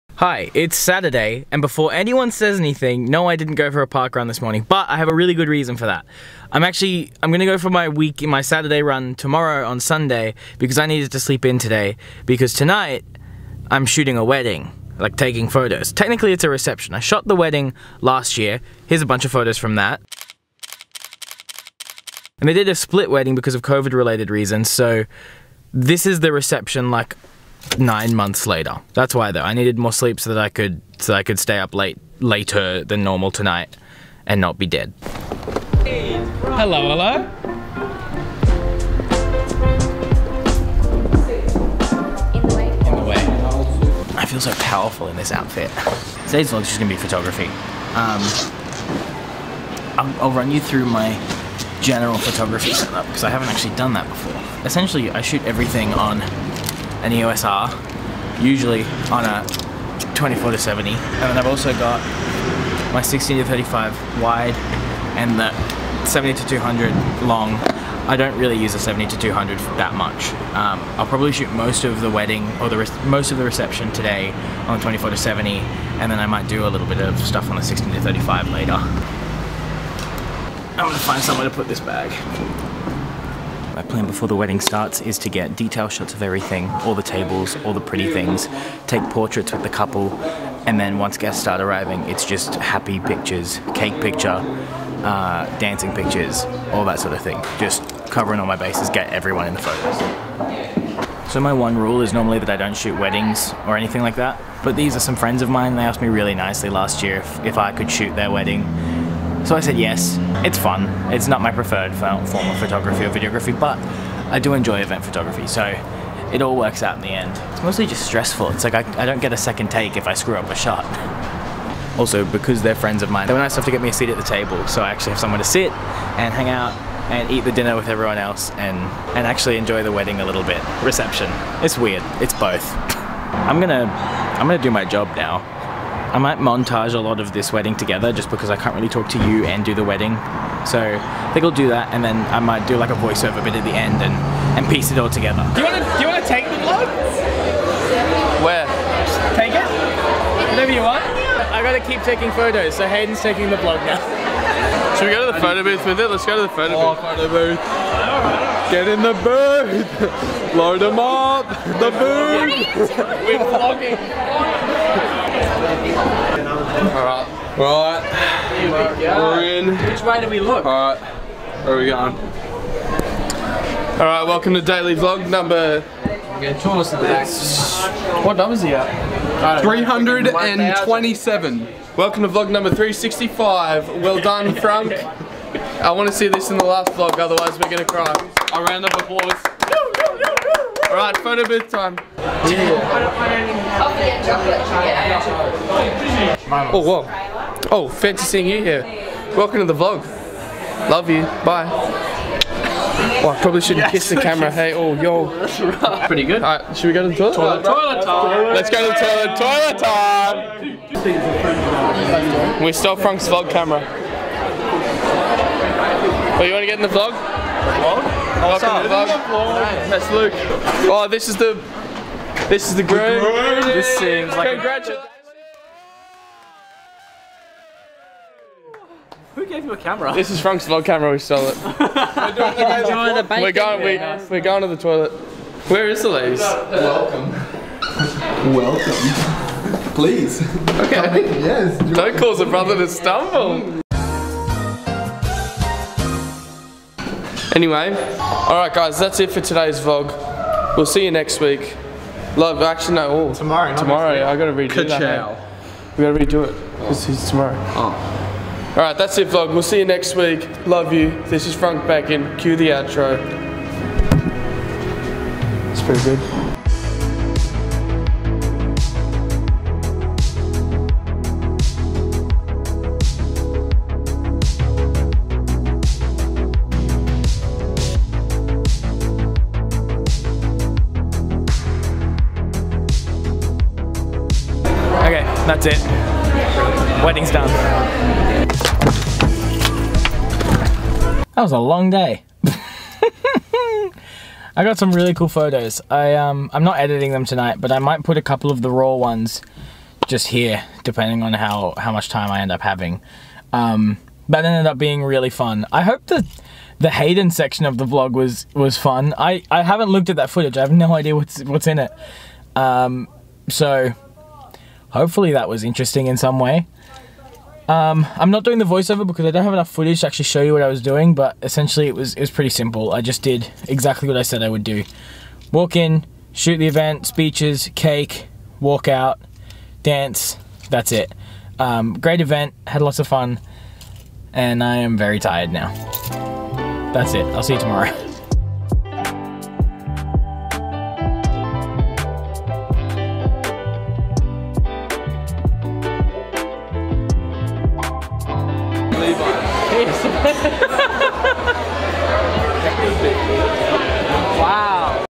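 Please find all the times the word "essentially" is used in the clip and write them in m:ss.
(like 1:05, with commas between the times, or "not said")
0:54, 5:21.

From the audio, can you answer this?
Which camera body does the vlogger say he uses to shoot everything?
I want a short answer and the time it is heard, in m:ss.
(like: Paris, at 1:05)
EOS R, at 0:57.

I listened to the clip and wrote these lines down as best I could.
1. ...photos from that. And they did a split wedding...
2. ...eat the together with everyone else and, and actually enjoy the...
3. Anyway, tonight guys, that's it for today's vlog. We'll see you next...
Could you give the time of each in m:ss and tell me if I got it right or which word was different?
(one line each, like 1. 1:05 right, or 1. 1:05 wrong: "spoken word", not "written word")
1. 0:19 right
2. 2:07 wrong: "dinner", not "together"
3. 4:07 wrong: "alright", not "tonight".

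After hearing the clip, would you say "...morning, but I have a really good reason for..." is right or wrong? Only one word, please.
right.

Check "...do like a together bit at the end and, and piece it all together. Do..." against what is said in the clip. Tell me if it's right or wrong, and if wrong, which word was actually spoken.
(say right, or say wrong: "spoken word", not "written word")
wrong: "voiceover", not "together".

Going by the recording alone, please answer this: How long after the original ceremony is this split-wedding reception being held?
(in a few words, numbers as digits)
9 months later.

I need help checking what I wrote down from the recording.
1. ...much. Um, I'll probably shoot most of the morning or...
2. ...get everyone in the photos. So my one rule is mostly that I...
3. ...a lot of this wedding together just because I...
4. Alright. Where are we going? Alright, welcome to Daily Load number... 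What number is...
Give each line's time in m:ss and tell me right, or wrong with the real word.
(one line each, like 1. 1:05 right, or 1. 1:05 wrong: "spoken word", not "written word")
1. 1:09 wrong: "wedding", not "morning"
2. 1:38 wrong: "normally", not "mostly"
3. 2:16 right
4. 2:50 wrong: "Vlog", not "Load".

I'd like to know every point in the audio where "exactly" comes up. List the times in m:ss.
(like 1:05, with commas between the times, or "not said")
5:23.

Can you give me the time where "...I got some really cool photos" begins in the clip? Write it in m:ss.
4:54.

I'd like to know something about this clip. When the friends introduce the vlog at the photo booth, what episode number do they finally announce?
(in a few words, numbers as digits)
365.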